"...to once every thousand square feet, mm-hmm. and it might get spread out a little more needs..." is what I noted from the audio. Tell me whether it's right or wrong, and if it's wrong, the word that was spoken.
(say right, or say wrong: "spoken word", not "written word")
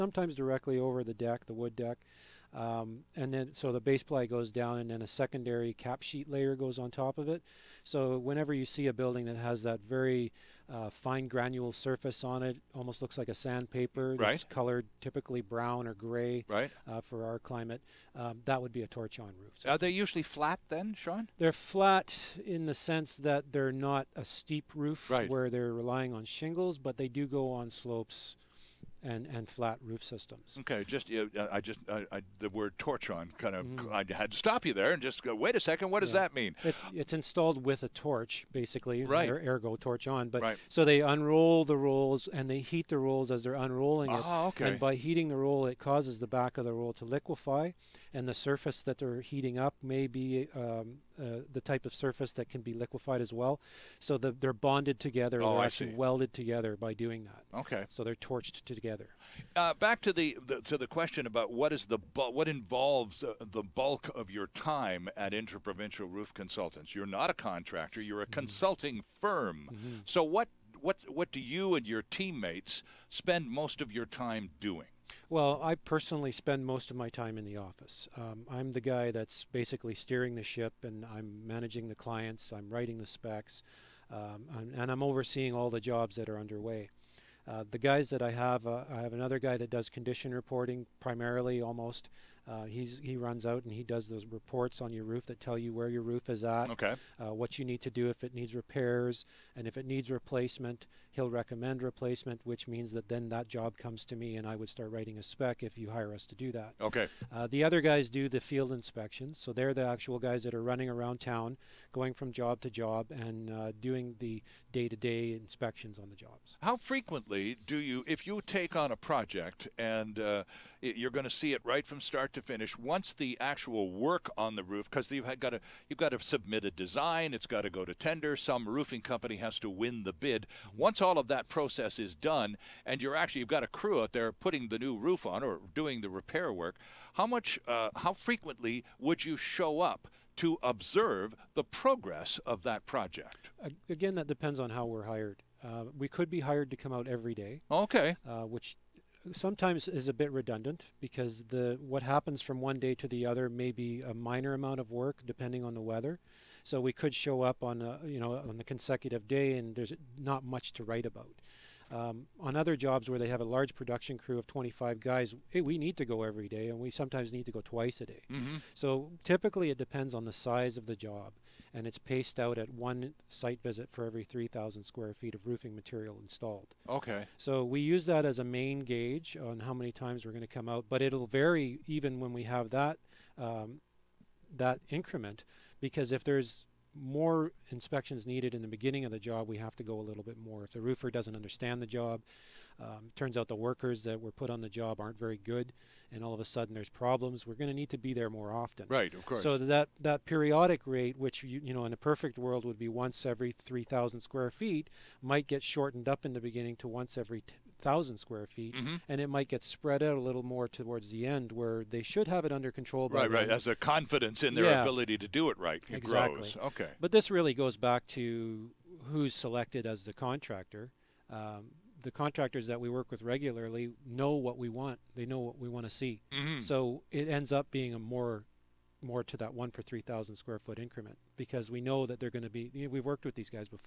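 wrong: "towards", not "needs".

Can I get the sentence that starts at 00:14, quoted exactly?
that's colored typically brown or gray right.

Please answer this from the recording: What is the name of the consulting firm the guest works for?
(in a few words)
Interprovincial Roof Consultants.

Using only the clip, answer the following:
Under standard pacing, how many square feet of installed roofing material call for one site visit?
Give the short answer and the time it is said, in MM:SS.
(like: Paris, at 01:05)
3,000, at 02:52.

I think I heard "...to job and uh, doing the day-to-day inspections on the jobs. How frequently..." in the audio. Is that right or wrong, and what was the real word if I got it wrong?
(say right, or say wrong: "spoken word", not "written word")
right.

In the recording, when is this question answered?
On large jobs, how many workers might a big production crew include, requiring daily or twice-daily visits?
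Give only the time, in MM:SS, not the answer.
02:44.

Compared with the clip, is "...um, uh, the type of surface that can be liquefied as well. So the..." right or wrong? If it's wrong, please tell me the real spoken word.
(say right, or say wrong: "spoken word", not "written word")
right.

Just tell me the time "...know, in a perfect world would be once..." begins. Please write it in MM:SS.
03:21.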